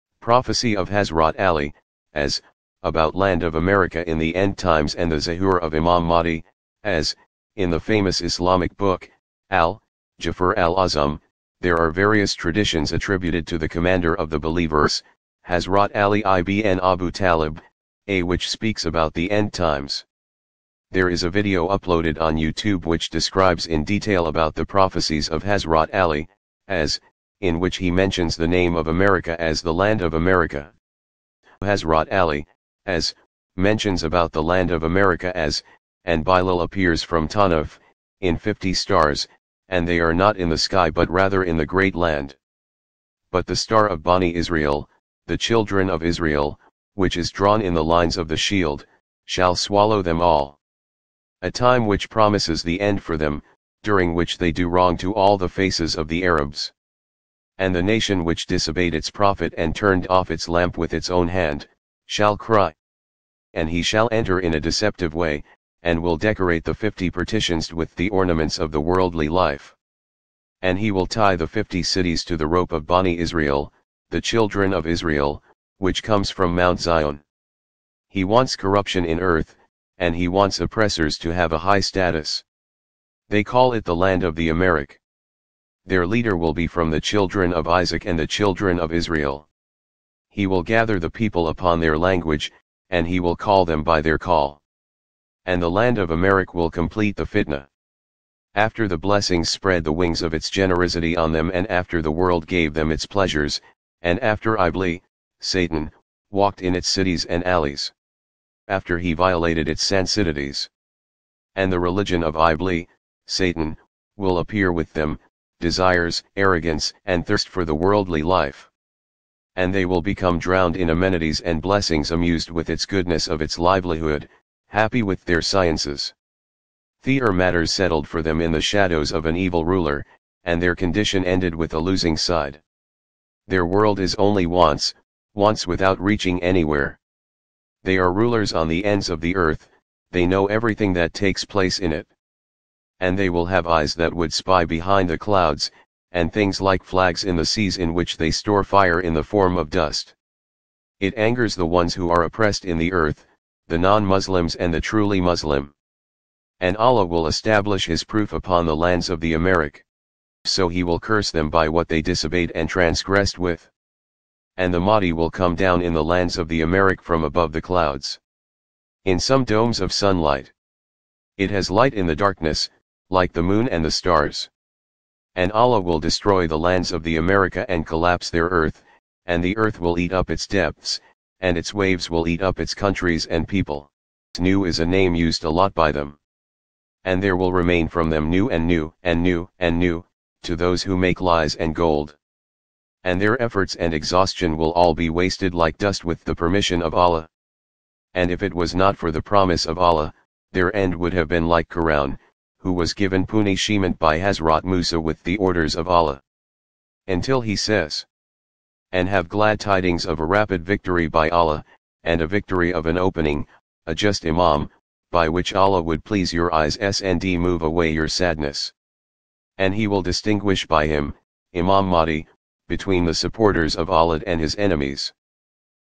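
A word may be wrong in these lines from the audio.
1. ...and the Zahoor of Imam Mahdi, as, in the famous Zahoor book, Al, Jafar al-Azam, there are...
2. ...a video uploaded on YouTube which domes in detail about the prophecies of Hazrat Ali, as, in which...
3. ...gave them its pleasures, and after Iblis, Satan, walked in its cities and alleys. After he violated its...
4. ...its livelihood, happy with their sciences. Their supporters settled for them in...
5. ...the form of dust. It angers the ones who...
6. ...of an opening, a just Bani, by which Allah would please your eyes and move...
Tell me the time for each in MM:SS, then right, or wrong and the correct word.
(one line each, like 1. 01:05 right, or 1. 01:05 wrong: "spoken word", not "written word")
1. 00:04 wrong: "Islamic", not "Zahoor"
2. 00:21 wrong: "describes", not "domes"
3. 01:42 right
4. 02:03 wrong: "matters", not "supporters"
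5. 02:29 right
6. 03:32 wrong: "Imam", not "Bani".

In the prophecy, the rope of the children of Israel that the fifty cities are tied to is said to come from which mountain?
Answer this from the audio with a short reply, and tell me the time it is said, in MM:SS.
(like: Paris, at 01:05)
Mount Zion, at 01:16.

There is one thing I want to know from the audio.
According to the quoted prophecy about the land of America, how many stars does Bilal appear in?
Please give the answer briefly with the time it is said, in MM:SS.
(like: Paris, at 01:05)
50, at 00:38.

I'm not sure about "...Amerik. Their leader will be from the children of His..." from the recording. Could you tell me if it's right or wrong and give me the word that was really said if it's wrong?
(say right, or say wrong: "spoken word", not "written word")
wrong: "Isaac", not "His".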